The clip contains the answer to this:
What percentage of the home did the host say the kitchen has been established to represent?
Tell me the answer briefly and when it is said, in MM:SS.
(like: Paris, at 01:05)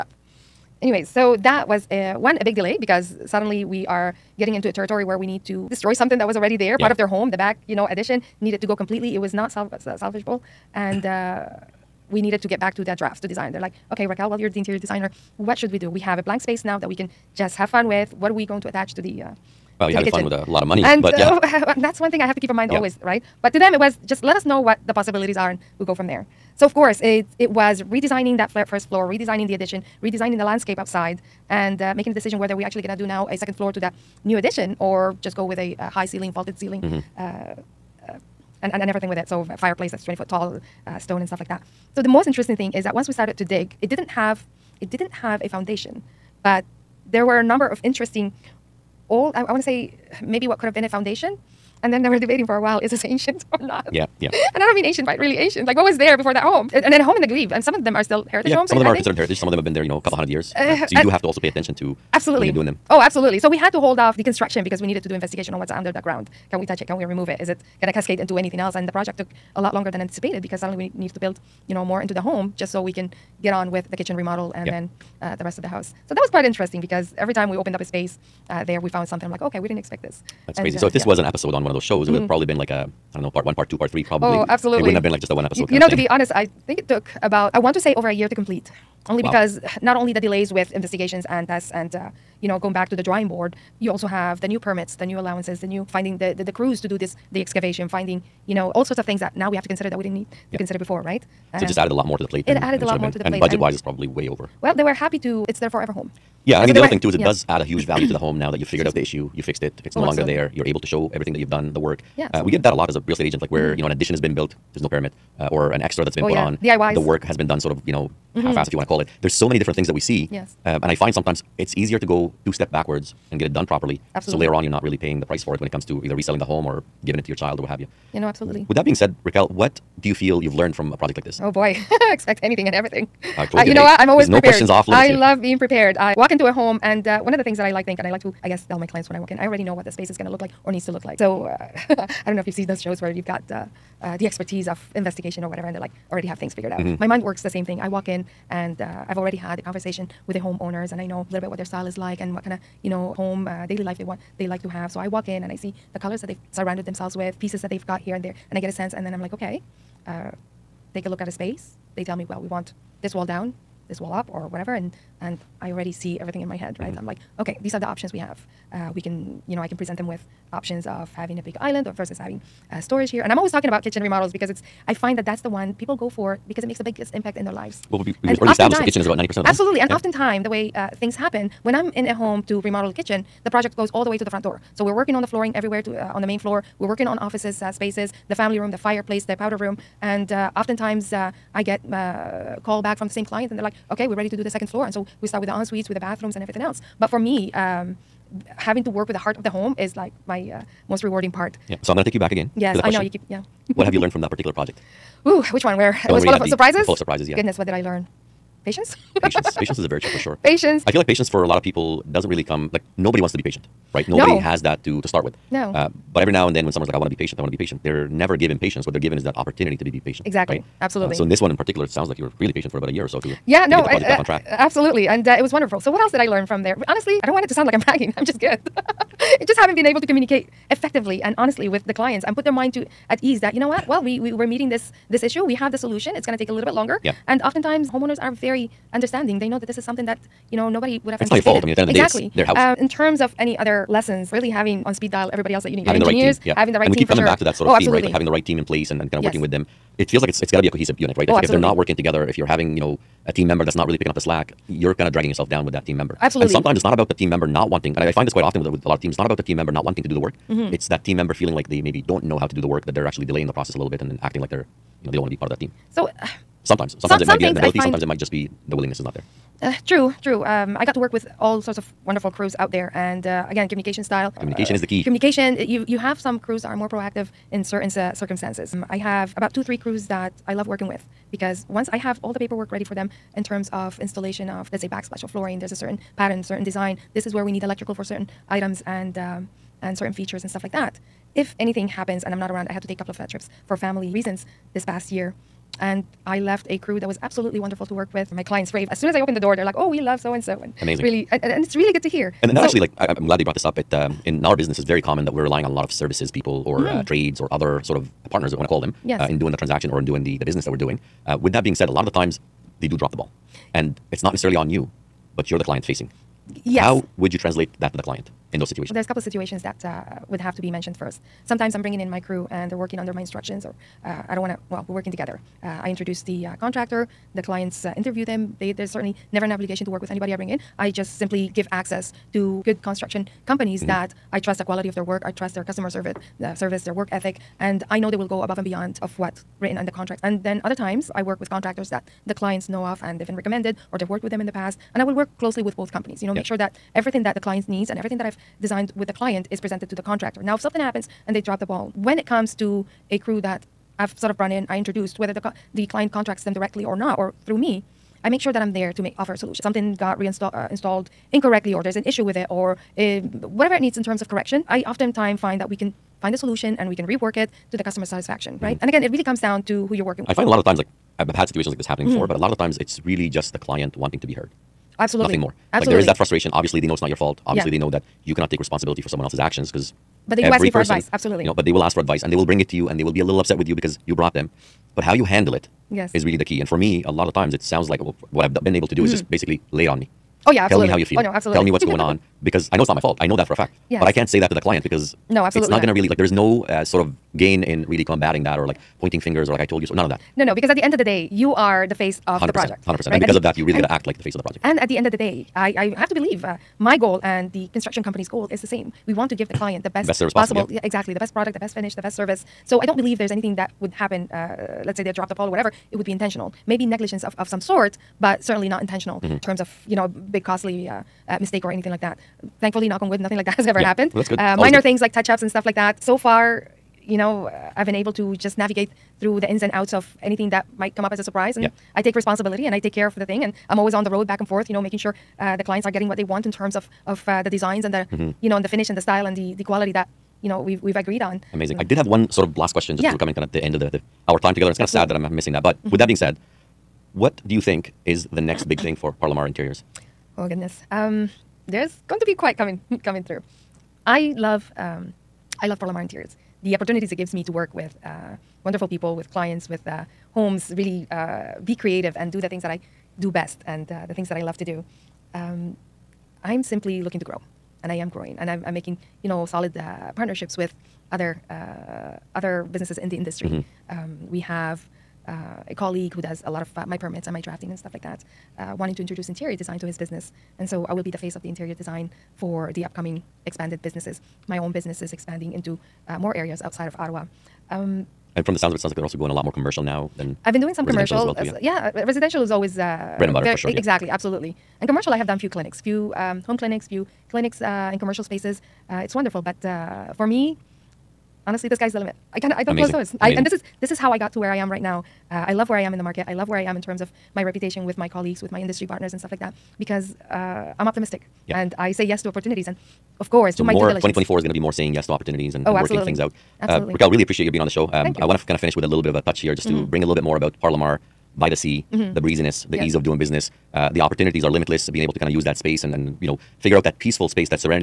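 90%, at 02:59.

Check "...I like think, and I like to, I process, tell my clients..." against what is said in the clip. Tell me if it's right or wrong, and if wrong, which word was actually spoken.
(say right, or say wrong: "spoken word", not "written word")
wrong: "guess", not "process".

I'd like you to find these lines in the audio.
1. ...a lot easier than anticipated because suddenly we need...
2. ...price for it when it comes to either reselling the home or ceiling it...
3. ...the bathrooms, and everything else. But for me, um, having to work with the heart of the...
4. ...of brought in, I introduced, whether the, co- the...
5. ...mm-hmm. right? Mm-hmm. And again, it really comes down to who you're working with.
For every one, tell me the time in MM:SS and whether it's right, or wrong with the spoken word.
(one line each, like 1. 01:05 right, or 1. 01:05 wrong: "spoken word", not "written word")
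1. 01:09 wrong: "longer", not "easier"
2. 02:05 wrong: "giving", not "ceiling"
3. 03:15 right
4. 05:54 right
5. 06:08 right.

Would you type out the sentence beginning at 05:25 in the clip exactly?
Uh, I introduce the uh, contractor the clients uh, interview them.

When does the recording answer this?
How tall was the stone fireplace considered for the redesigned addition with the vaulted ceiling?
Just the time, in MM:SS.
00:40.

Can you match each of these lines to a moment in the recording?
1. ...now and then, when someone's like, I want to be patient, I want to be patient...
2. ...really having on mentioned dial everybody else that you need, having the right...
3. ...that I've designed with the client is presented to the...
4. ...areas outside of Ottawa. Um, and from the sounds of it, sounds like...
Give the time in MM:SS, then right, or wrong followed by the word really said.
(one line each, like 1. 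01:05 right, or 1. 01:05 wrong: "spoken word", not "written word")
1. 03:36 right
2. 04:04 wrong: "speed", not "mentioned"
3. 05:48 right
4. 08:06 right.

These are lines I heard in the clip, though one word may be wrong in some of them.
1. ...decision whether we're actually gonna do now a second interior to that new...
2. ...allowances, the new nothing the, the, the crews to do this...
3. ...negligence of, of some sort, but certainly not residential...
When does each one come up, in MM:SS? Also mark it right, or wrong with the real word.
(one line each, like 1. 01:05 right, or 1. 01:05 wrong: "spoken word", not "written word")
1. 00:32 wrong: "floor", not "interior"
2. 01:35 wrong: "finding", not "nothing"
3. 06:56 wrong: "intentional", not "residential".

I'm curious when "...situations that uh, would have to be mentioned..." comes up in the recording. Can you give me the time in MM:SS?
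05:19.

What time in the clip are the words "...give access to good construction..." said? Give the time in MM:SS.
05:31.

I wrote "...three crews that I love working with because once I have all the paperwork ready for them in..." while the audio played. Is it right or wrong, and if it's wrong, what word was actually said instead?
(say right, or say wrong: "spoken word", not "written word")
right.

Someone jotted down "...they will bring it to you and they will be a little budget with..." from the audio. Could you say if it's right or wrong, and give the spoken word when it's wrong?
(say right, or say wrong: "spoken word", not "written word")
wrong: "upset", not "budget".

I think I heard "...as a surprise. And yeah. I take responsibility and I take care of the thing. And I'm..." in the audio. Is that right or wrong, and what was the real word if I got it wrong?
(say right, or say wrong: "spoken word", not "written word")
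right.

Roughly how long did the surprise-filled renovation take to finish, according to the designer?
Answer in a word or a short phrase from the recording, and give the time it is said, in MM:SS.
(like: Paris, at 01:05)
over a year, at 01:27.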